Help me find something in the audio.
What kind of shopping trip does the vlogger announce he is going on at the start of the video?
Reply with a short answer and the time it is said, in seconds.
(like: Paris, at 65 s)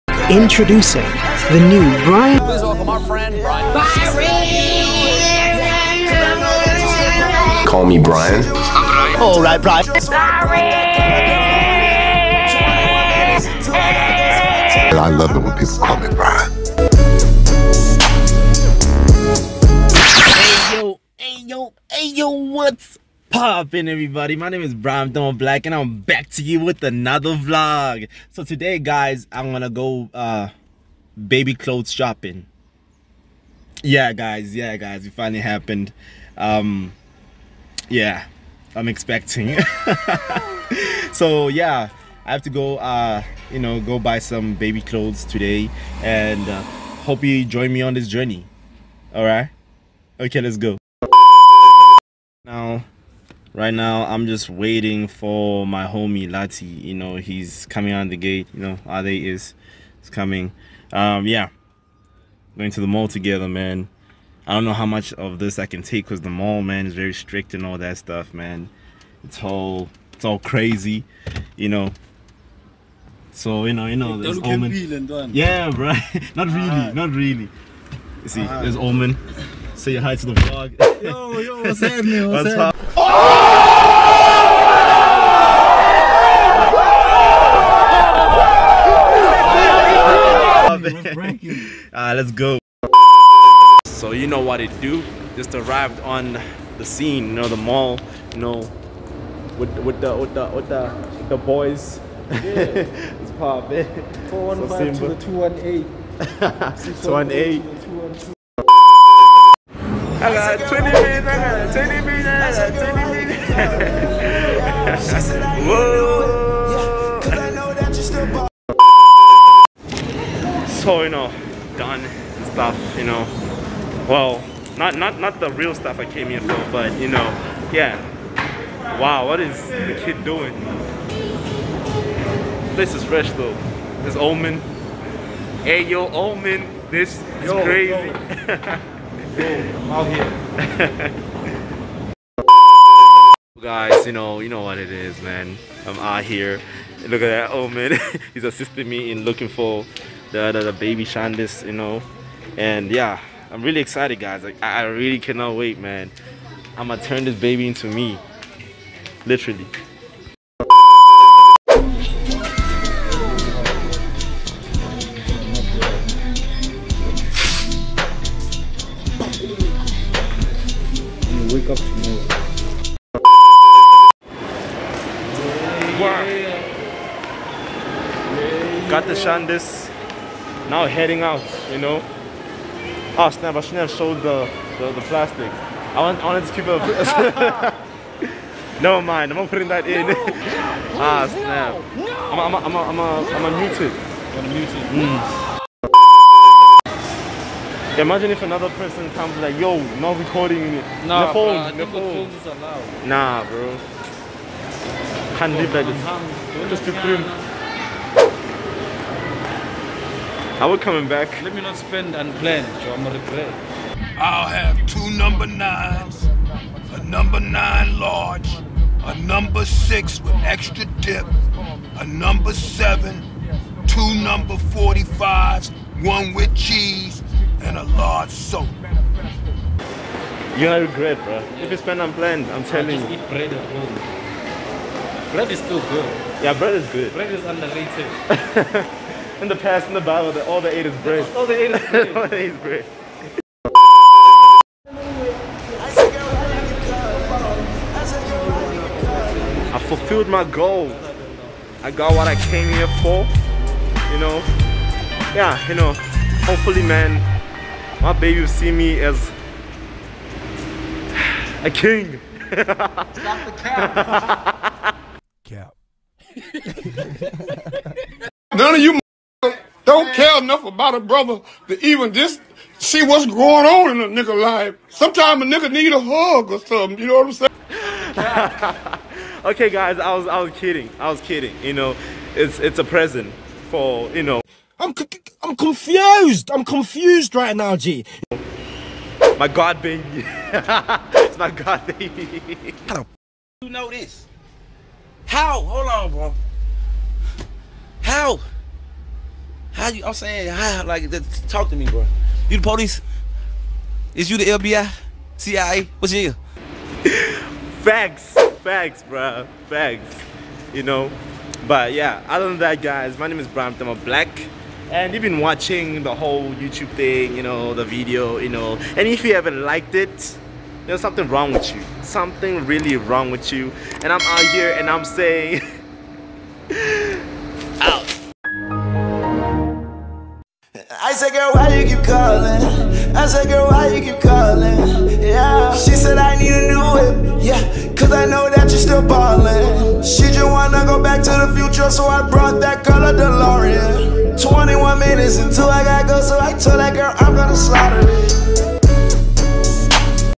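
baby clothes shopping, at 31 s.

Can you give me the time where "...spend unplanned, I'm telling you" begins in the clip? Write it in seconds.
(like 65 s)
231 s.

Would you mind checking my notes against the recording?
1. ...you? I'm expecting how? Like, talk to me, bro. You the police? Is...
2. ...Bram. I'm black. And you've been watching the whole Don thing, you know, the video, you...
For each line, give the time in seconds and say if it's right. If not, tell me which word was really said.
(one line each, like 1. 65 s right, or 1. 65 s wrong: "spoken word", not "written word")
1. 299 s wrong: "saying", not "expecting"
2. 313 s wrong: "YouTube", not "Don".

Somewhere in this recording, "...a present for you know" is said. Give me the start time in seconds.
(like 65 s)
282 s.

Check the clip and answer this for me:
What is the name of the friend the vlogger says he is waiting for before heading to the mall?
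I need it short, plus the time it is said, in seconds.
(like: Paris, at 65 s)
Lati, at 56 s.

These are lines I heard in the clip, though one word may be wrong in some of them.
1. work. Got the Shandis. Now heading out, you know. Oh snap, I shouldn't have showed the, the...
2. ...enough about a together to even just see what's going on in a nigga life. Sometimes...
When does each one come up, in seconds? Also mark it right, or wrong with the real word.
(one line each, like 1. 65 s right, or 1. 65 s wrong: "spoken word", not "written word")
1. 176 s right
2. 270 s wrong: "brother", not "together".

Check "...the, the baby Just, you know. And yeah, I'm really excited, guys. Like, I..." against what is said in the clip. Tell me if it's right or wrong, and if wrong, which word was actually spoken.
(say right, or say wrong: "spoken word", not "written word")
wrong: "Shandis", not "Just".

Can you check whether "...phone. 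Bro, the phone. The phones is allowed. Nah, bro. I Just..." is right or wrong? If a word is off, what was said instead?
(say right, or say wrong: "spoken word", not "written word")
right.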